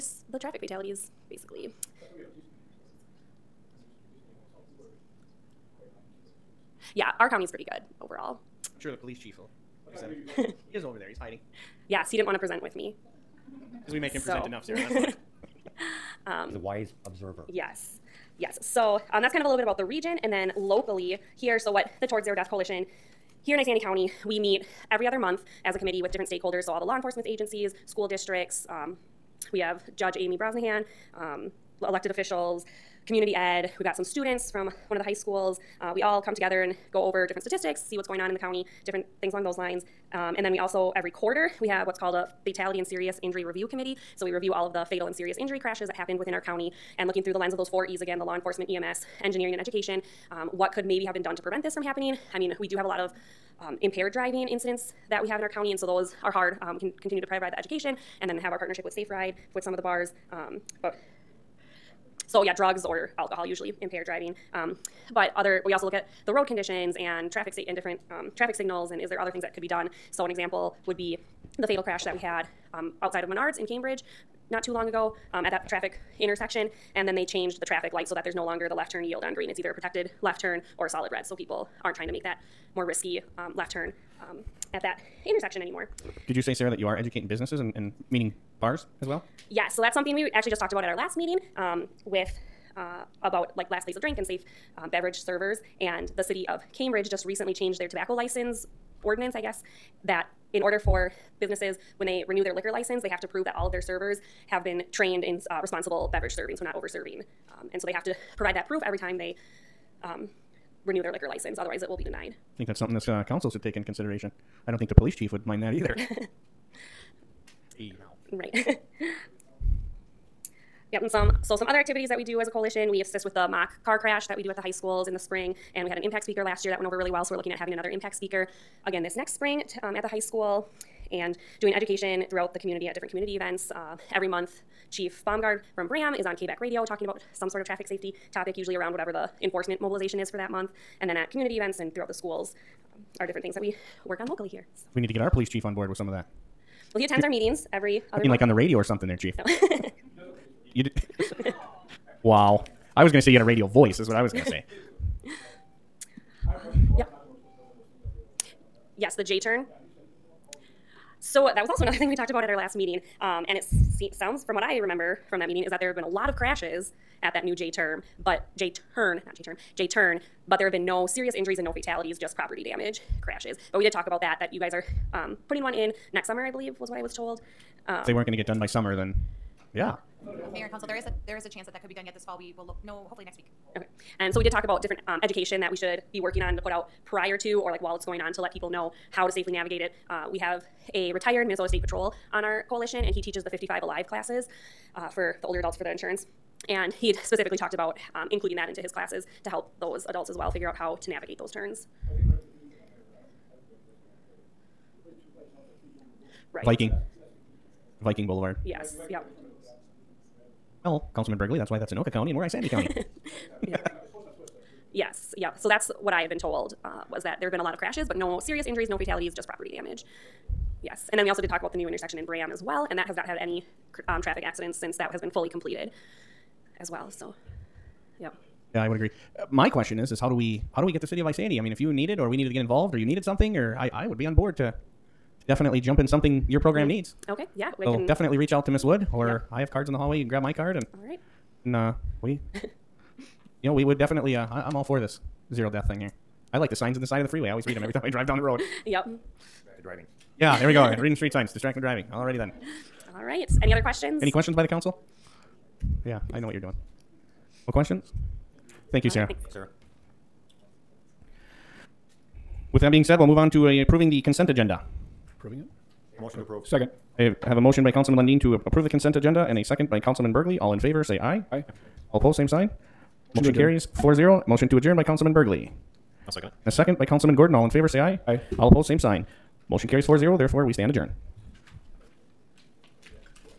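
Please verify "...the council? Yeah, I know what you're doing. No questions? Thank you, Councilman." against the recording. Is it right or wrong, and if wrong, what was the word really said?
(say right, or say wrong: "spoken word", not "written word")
wrong: "Sarah", not "Councilman".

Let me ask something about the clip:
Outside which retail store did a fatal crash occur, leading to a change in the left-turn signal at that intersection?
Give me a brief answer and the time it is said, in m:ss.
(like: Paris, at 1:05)
Menards, at 1:13.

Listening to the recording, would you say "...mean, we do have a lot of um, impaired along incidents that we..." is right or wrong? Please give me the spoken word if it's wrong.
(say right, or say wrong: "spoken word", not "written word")
wrong: "driving", not "along".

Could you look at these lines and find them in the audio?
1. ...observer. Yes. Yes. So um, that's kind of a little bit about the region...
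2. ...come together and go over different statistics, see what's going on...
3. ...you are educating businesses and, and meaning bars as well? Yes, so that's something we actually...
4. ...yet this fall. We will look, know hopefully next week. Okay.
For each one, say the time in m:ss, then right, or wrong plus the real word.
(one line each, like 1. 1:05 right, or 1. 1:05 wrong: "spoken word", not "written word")
1. 0:17 right
2. 0:36 right
3. 1:26 right
4. 3:02 right.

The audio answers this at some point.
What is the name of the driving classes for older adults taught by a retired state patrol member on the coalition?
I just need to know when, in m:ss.
3:13.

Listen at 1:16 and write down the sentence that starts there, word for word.
And then they changed the traffic light so that there's no longer the left turn yield on green.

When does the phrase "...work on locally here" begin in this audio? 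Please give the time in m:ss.
2:24.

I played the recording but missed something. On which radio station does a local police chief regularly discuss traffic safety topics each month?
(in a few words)
KBEK Radio.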